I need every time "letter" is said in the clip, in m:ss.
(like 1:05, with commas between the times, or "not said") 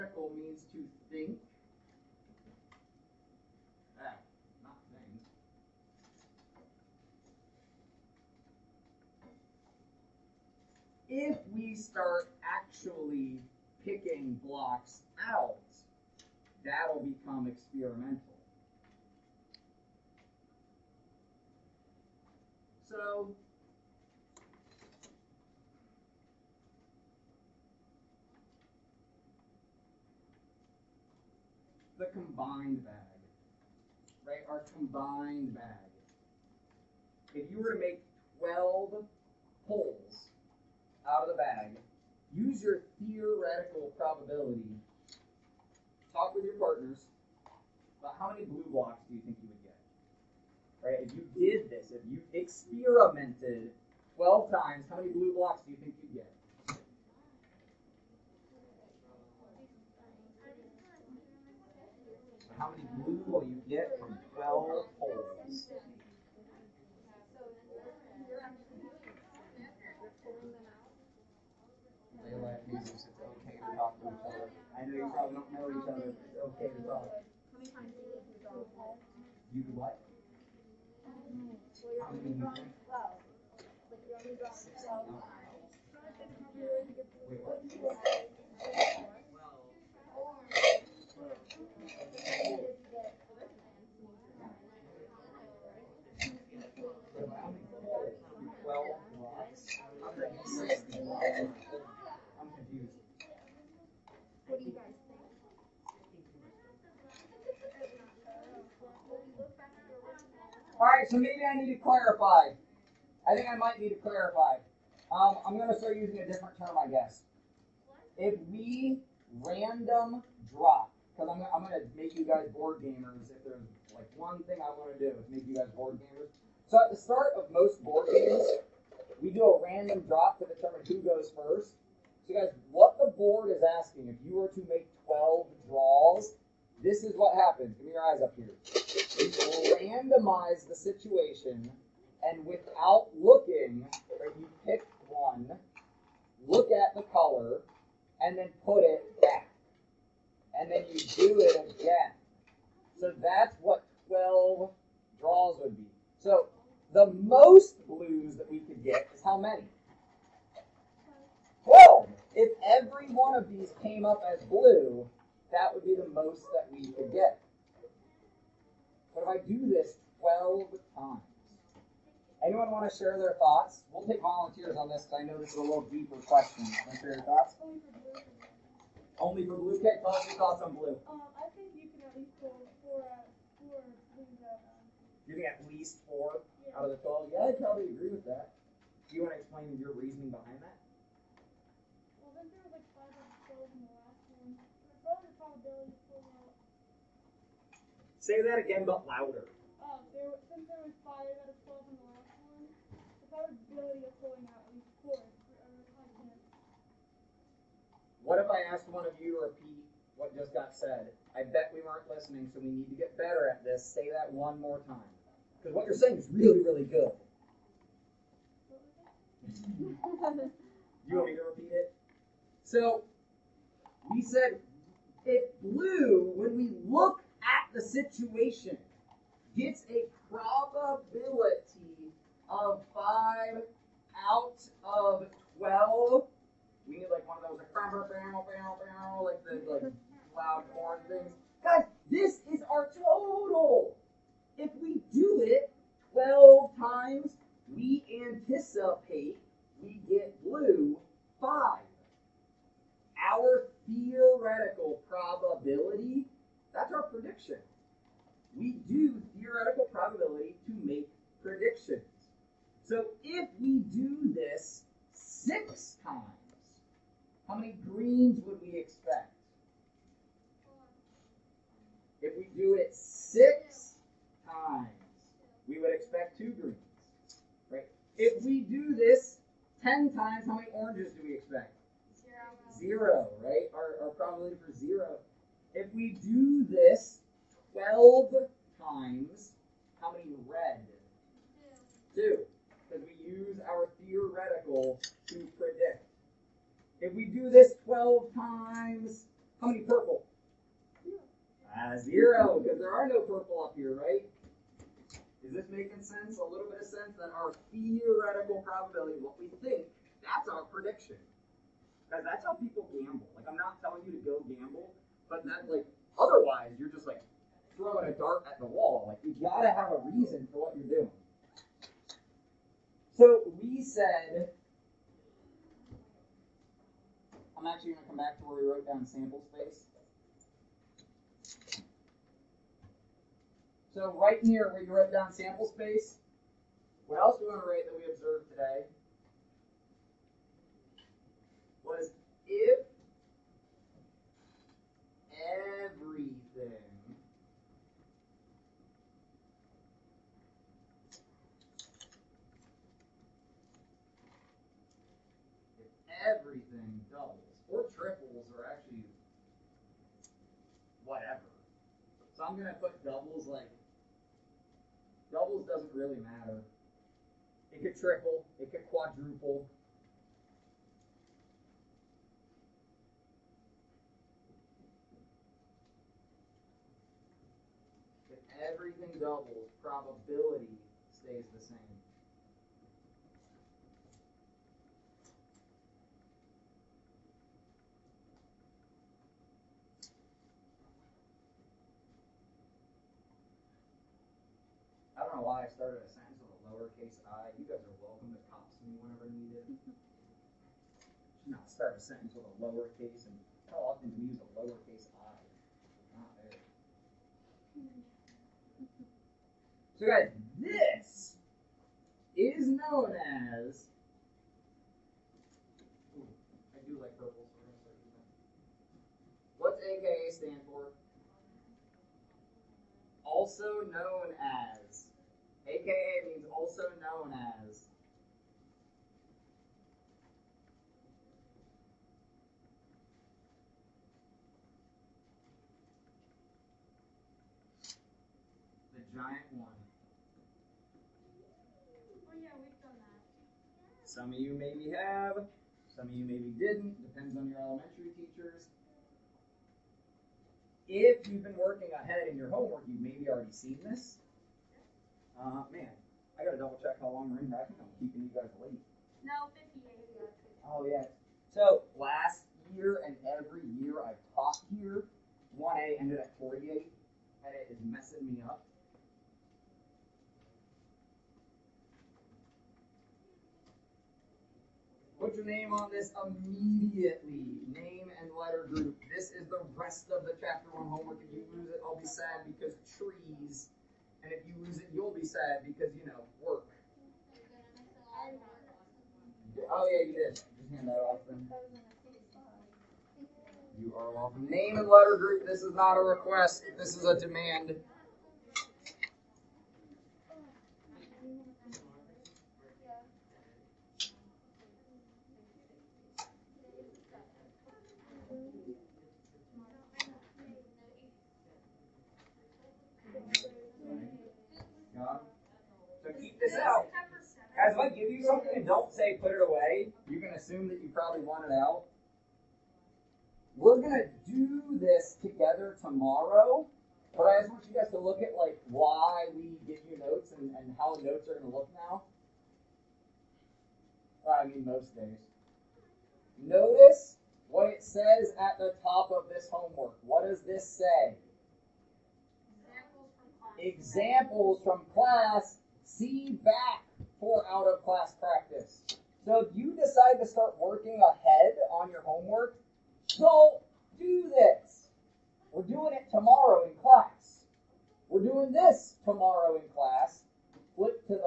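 7:58, 8:14.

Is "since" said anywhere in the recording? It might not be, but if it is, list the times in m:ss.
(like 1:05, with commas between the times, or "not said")
3:20.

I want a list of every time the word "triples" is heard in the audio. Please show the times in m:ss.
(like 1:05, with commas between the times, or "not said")
5:57, 6:07.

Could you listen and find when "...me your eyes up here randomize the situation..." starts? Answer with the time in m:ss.
2:17.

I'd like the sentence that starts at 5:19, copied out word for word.
Like you gotta have a reason for what you're doing.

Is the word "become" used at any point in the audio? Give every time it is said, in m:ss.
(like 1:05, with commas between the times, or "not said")
0:17.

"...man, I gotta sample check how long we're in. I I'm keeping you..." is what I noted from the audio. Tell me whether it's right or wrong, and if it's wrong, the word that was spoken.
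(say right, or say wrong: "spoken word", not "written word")
wrong: "double", not "sample".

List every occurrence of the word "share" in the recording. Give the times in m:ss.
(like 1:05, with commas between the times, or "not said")
2:52, 2:57.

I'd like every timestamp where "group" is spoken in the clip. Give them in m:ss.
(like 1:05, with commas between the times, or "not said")
7:58, 8:15.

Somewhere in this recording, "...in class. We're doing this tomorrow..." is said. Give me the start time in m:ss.
9:16.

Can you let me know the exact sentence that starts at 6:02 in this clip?
So I'm gonna put doubles like doubles doesn't really matter.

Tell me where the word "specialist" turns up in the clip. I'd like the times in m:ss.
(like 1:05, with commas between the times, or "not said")
not said.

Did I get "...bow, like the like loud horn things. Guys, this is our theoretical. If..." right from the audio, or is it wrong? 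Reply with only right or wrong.
wrong.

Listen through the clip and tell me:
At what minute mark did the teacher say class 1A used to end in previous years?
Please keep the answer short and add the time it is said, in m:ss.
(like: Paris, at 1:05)
48, at 7:46.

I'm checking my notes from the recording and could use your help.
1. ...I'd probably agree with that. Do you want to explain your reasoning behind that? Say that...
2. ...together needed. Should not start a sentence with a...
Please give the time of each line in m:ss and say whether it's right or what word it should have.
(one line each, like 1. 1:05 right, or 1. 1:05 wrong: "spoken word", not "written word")
1. 3:07 right
2. 6:39 wrong: "whenever", not "together".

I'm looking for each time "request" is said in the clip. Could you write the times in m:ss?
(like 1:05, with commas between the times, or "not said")
8:16.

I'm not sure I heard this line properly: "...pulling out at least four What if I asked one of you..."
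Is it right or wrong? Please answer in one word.
right.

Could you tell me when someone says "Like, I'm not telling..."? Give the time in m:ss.
5:13.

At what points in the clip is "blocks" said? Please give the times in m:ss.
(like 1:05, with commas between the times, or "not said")
0:14, 0:48, 0:55.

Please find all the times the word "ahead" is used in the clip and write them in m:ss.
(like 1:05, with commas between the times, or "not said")
7:31, 9:11.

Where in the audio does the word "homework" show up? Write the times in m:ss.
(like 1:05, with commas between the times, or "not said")
7:32, 8:00, 8:59, 9:12.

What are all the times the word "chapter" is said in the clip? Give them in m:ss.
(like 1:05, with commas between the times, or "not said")
8:00.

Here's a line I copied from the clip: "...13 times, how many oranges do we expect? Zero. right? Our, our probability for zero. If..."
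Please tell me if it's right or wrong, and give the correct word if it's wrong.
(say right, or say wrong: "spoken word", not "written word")
wrong: "10", not "13".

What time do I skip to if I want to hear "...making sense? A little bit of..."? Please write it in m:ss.
5:05.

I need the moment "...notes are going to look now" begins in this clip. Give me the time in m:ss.
8:51.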